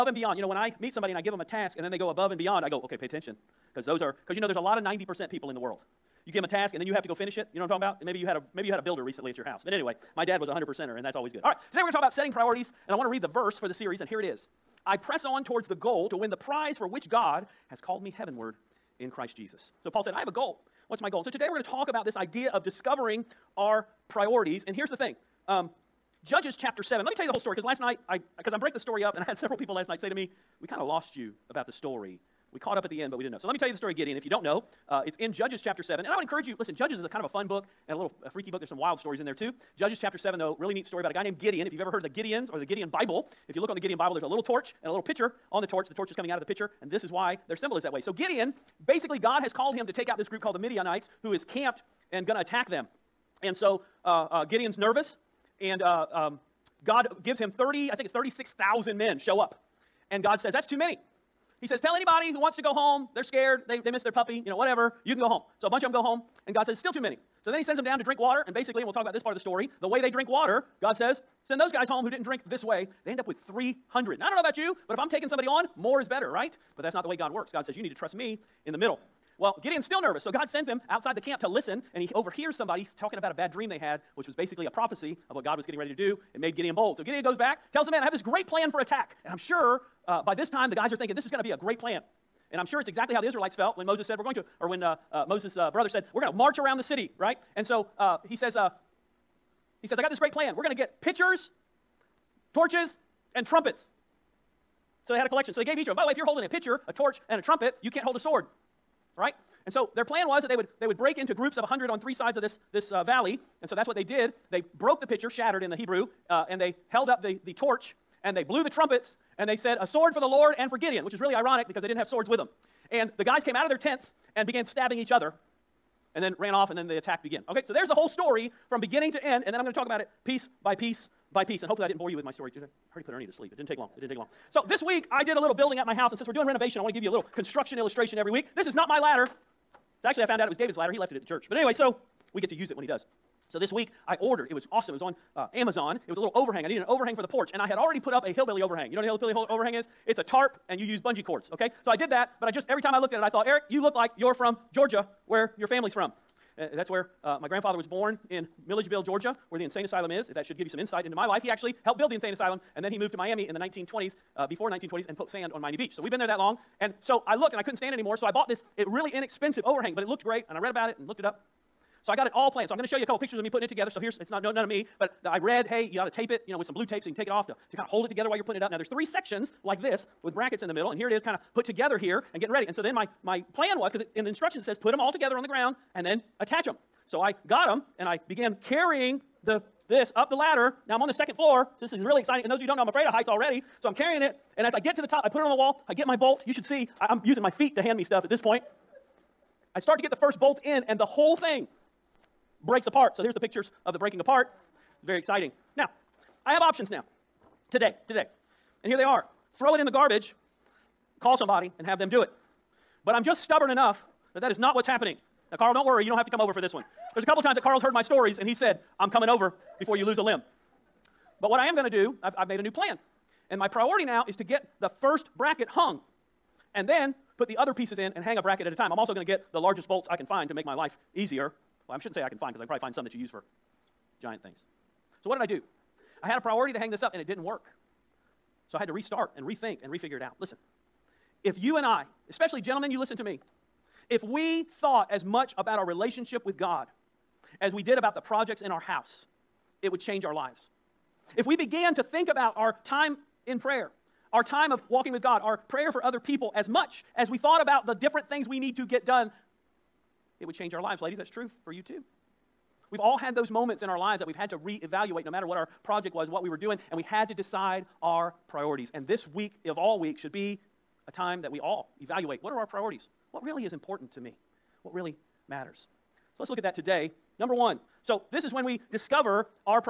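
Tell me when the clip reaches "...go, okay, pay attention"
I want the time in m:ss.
0:02.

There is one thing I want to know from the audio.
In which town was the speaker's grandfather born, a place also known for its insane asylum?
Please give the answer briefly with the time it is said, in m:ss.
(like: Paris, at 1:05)
Milledgeville, Georgia, at 2:38.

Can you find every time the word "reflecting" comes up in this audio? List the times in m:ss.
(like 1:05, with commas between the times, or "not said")
not said.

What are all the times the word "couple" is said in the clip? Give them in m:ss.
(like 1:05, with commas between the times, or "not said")
2:53, 3:37.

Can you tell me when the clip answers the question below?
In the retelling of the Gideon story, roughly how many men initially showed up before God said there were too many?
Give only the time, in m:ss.
0:58.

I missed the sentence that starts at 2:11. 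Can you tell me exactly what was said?
And hopefully, I didn't bore you with my story today.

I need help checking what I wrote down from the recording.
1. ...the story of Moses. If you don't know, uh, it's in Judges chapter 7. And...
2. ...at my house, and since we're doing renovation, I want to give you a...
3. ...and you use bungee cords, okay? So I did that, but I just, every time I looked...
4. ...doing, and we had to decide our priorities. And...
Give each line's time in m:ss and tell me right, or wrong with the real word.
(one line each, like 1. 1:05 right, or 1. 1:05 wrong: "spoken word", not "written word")
1. 0:33 wrong: "Gideon", not "Moses"
2. 2:15 right
3. 2:30 right
4. 4:26 right.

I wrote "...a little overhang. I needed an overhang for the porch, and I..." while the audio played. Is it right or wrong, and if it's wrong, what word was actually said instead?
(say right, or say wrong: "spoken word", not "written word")
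right.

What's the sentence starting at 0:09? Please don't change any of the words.
But anyway, my dad was a 100%er, and that's always good.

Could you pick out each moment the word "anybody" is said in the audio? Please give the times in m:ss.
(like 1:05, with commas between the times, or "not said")
1:01.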